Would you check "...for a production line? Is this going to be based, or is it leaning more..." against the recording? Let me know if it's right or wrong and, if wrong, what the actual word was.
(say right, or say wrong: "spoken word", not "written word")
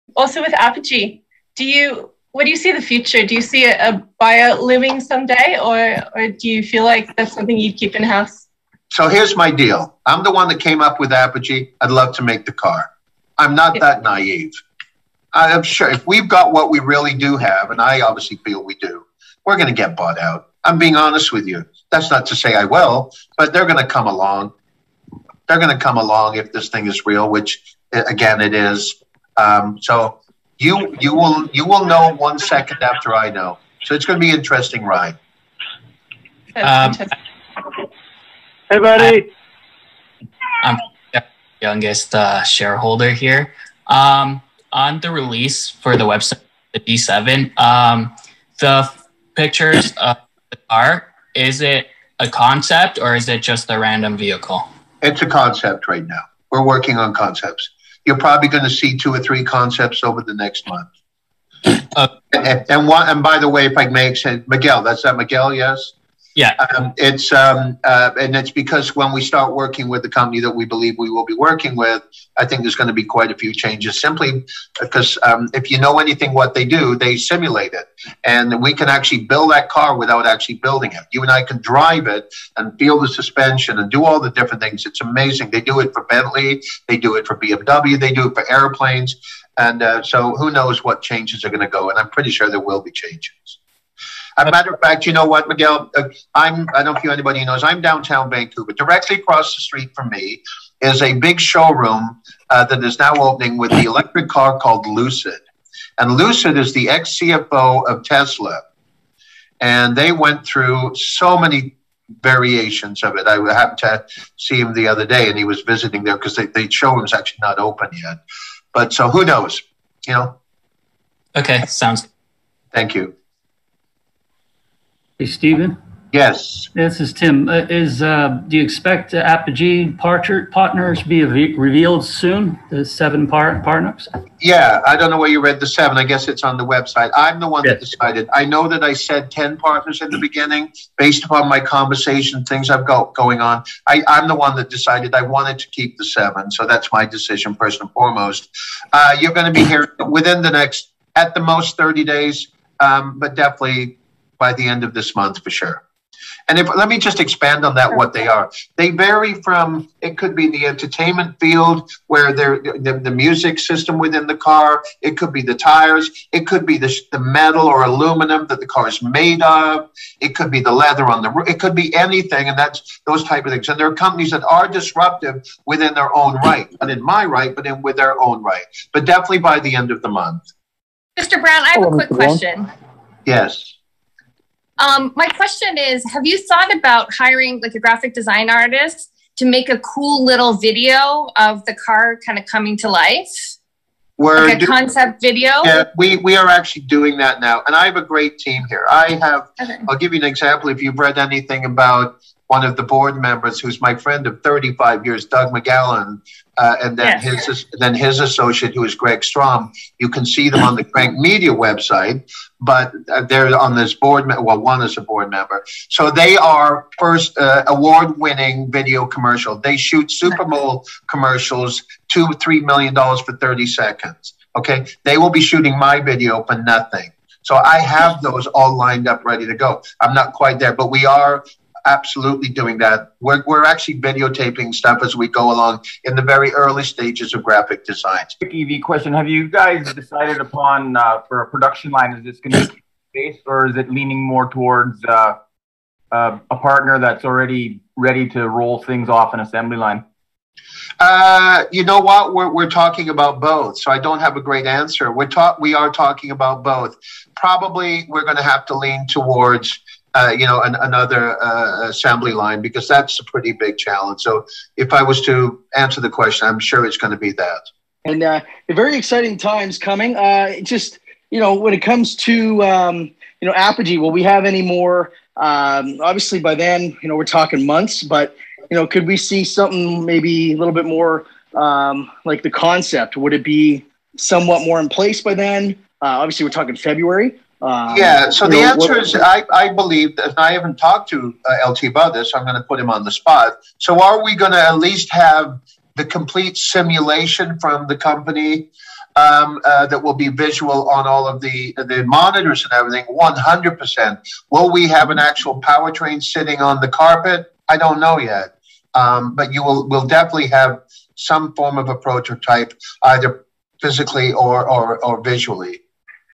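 right.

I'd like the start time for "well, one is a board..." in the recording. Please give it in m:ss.
3:34.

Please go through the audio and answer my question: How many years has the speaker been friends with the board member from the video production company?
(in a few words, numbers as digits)
35.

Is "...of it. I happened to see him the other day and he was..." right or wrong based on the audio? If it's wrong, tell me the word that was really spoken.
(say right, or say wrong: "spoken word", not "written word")
right.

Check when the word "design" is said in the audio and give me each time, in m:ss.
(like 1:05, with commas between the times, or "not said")
3:08, 3:57.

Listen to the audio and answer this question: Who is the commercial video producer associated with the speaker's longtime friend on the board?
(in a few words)
Greg Strom.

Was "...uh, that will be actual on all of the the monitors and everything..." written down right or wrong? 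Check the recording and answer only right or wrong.
wrong.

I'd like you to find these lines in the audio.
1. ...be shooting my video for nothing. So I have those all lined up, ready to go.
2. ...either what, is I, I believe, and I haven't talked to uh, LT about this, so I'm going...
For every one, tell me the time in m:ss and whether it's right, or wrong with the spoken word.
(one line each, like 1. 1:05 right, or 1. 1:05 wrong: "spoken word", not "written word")
1. 3:45 right
2. 4:48 wrong: "answer", not "either".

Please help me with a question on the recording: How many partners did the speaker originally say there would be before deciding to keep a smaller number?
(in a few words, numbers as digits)
10.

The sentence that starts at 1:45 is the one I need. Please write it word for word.
And Lucid is the ex CFO of Tesla.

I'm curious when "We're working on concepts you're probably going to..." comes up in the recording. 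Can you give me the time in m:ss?
0:56.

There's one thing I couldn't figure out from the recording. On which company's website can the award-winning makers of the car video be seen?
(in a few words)
Crank Media.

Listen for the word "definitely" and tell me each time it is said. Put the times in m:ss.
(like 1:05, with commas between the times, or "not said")
2:33, 2:59, 5:10.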